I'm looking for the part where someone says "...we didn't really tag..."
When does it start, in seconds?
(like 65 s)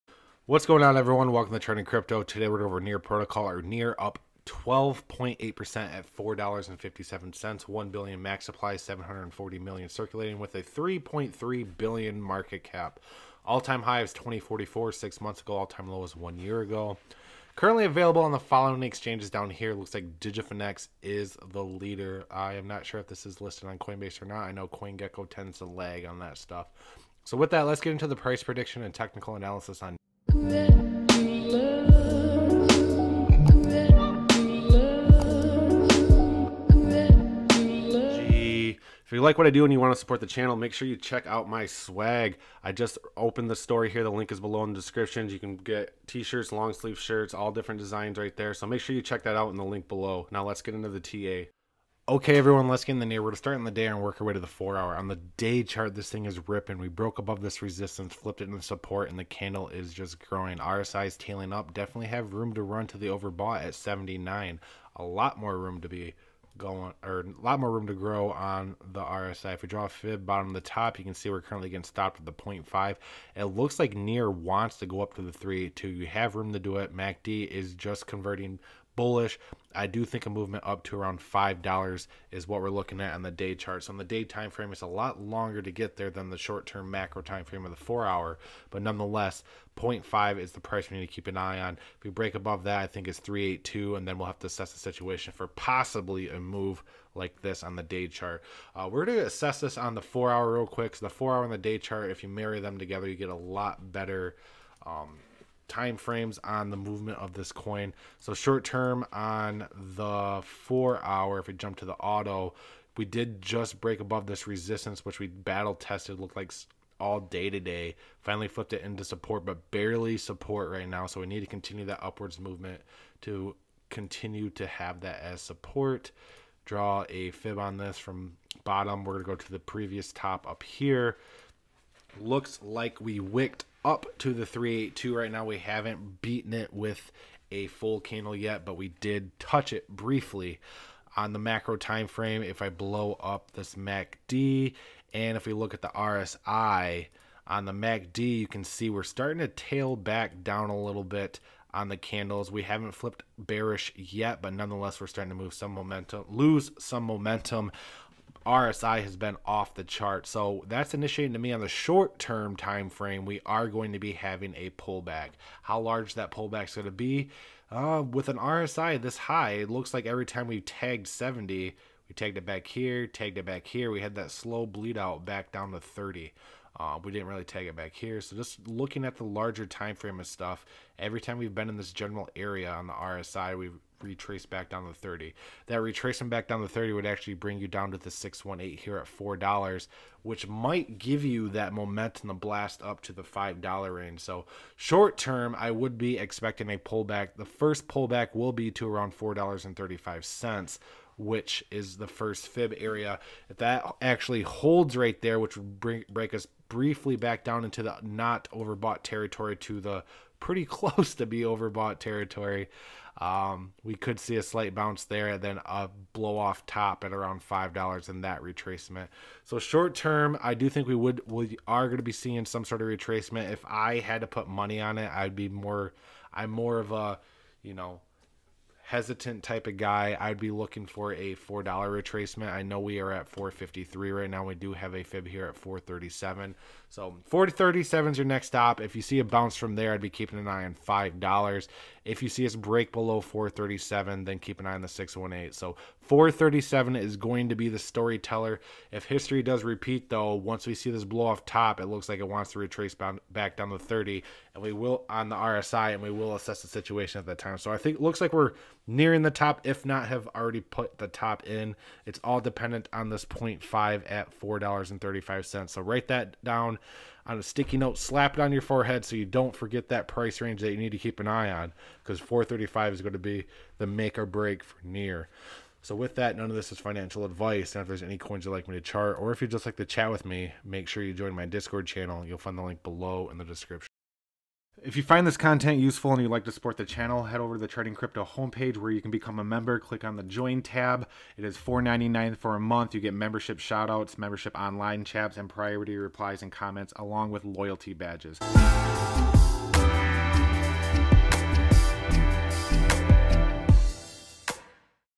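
177 s.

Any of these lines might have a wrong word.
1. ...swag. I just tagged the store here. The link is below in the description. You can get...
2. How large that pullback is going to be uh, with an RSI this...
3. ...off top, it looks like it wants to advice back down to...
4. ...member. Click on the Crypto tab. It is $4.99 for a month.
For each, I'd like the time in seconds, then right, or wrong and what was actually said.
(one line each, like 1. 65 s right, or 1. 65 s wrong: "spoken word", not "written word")
1. 41 s wrong: "opened", not "tagged"
2. 165 s right
3. 251 s wrong: "retrace", not "advice"
4. 289 s wrong: "Join", not "Crypto".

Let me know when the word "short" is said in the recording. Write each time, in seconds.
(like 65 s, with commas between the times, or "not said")
86 s, 108 s, 161 s, 194 s, 219 s.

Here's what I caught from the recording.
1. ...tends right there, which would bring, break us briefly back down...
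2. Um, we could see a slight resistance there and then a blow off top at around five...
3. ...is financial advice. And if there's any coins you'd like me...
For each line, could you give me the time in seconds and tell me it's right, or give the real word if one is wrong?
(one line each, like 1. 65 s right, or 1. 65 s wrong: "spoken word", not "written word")
1. 204 s wrong: "holds", not "tends"
2. 213 s wrong: "bounce", not "resistance"
3. 276 s right.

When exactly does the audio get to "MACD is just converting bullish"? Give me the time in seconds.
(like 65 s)
76 s.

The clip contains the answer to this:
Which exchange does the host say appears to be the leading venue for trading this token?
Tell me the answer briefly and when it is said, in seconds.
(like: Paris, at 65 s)
Digifinex, at 20 s.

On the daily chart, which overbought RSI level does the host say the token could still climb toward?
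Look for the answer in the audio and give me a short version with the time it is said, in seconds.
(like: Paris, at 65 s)
79, at 63 s.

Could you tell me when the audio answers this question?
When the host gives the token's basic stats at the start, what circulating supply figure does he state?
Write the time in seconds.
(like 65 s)
8 s.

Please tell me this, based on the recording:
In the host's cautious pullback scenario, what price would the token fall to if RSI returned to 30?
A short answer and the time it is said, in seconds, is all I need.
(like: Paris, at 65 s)
$4, at 189 s.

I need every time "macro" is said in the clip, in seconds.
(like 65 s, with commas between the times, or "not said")
86 s, 141 s.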